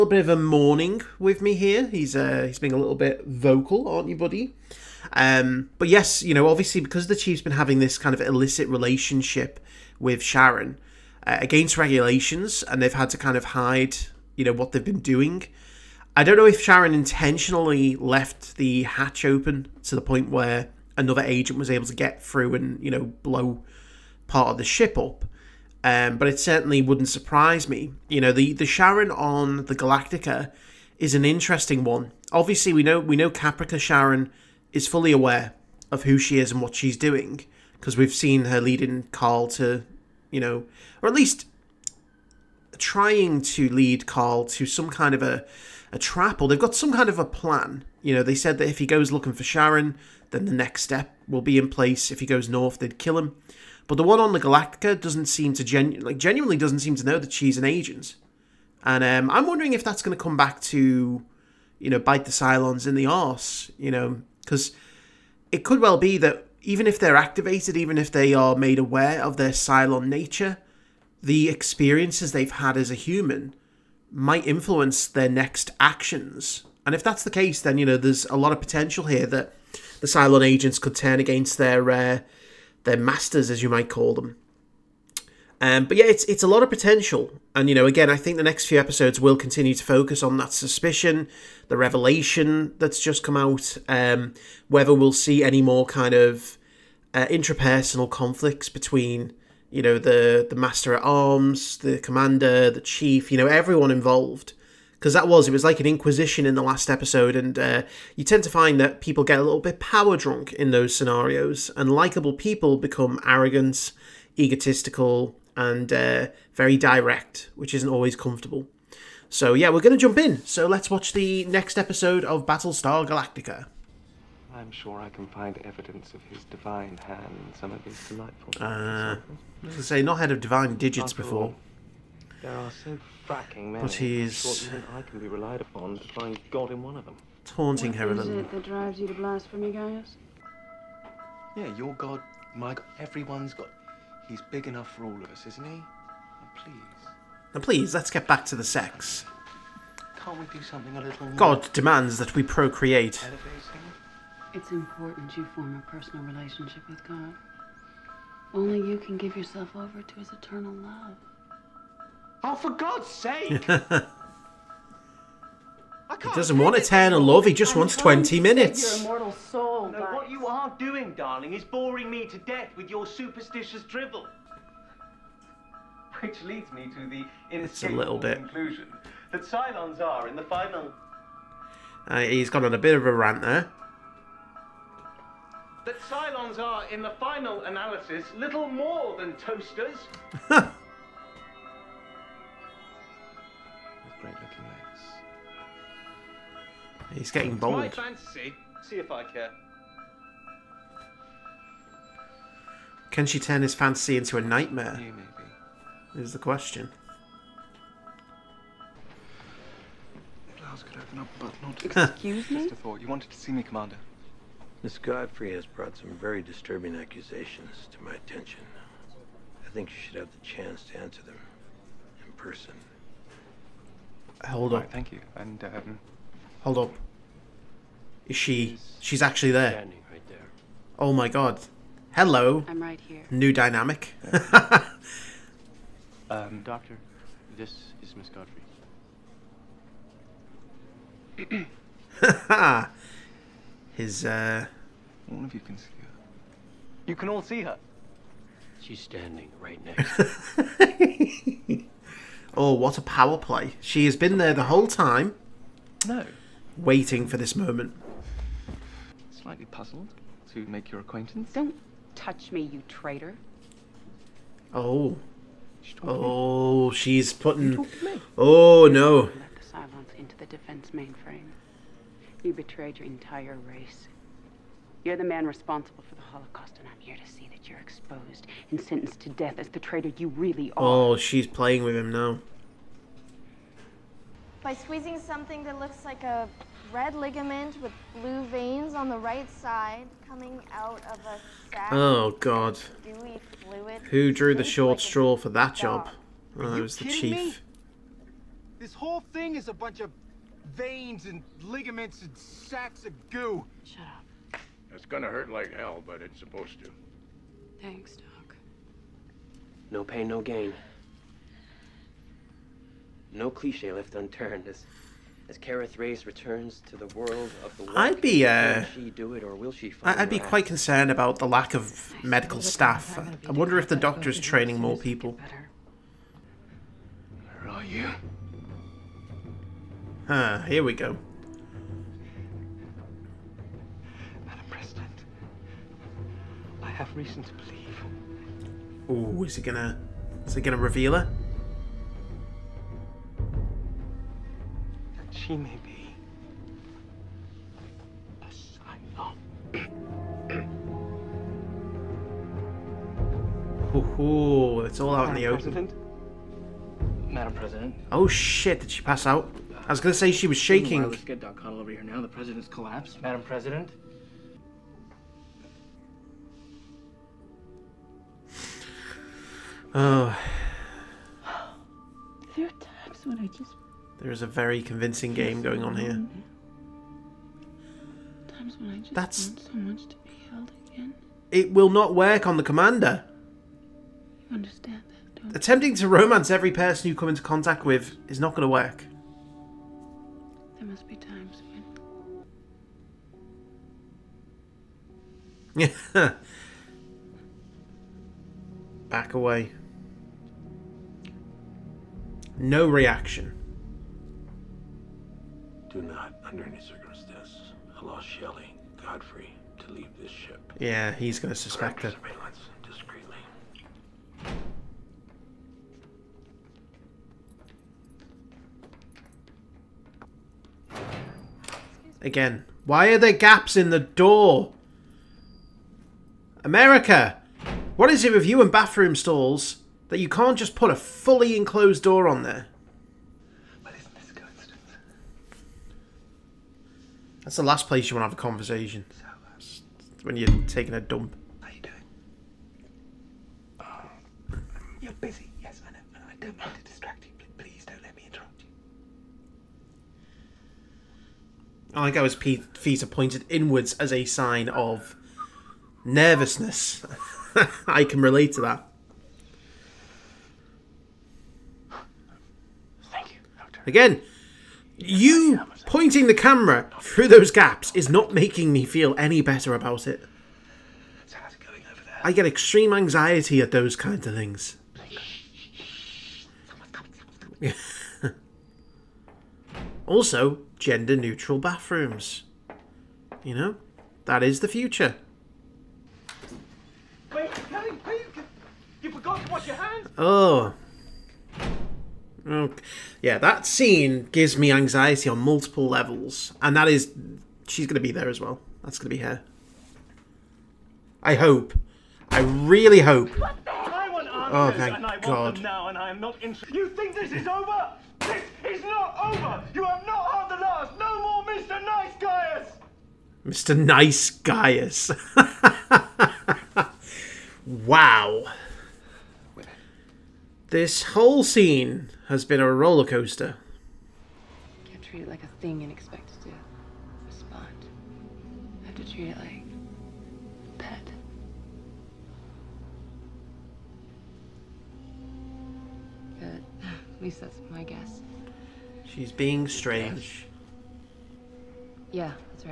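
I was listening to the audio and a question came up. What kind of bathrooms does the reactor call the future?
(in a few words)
Gender neutral.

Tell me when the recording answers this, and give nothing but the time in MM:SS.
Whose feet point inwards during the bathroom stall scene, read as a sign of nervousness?
07:31.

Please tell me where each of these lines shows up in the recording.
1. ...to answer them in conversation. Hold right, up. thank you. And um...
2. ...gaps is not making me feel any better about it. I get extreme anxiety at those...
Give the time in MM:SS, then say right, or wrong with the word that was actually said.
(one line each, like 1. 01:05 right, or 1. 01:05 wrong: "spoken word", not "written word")
1. 03:40 wrong: "person", not "conversation"
2. 07:47 right.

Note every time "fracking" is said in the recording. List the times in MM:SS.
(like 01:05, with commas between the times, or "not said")
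02:13.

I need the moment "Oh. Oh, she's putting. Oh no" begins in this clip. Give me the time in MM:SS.
04:24.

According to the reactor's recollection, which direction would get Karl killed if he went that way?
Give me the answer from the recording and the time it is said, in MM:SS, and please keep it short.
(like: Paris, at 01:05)
North, at 00:52.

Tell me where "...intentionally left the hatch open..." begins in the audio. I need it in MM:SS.
00:16.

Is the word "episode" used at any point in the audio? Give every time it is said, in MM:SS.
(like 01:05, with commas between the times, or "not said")
01:28, 01:46, 02:01.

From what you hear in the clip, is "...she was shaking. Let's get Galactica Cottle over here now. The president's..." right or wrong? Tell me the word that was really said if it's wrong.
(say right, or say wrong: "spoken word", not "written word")
wrong: "Doc", not "Galactica".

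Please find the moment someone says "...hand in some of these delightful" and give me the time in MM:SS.
02:06.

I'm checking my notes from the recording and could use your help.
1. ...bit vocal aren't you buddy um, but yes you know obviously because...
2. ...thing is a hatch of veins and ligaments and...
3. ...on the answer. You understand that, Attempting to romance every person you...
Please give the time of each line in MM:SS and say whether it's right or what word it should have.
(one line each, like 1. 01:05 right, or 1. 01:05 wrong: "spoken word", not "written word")
1. 00:02 right
2. 04:59 wrong: "bunch", not "hatch"
3. 06:22 wrong: "commander", not "answer".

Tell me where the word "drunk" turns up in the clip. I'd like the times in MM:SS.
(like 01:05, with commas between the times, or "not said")
01:50.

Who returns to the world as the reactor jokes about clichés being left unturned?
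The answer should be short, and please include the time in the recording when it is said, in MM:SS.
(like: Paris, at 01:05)
Kara Thrace, at 05:15.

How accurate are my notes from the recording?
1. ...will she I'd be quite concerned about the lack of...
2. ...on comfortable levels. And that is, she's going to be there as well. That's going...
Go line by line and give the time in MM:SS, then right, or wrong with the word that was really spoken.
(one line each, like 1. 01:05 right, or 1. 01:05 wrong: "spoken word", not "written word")
1. 05:19 right
2. 08:15 wrong: "multiple", not "comfortable".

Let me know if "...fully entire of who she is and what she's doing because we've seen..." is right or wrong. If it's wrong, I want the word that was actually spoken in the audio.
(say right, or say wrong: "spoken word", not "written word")
wrong: "aware", not "entire".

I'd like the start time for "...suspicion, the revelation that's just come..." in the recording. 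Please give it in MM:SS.
01:30.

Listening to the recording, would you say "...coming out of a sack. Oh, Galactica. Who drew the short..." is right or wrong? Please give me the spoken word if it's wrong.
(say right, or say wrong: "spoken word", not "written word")
wrong: "God", not "Galactica".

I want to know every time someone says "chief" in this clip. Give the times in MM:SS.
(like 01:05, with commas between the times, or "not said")
00:07, 01:42, 04:57.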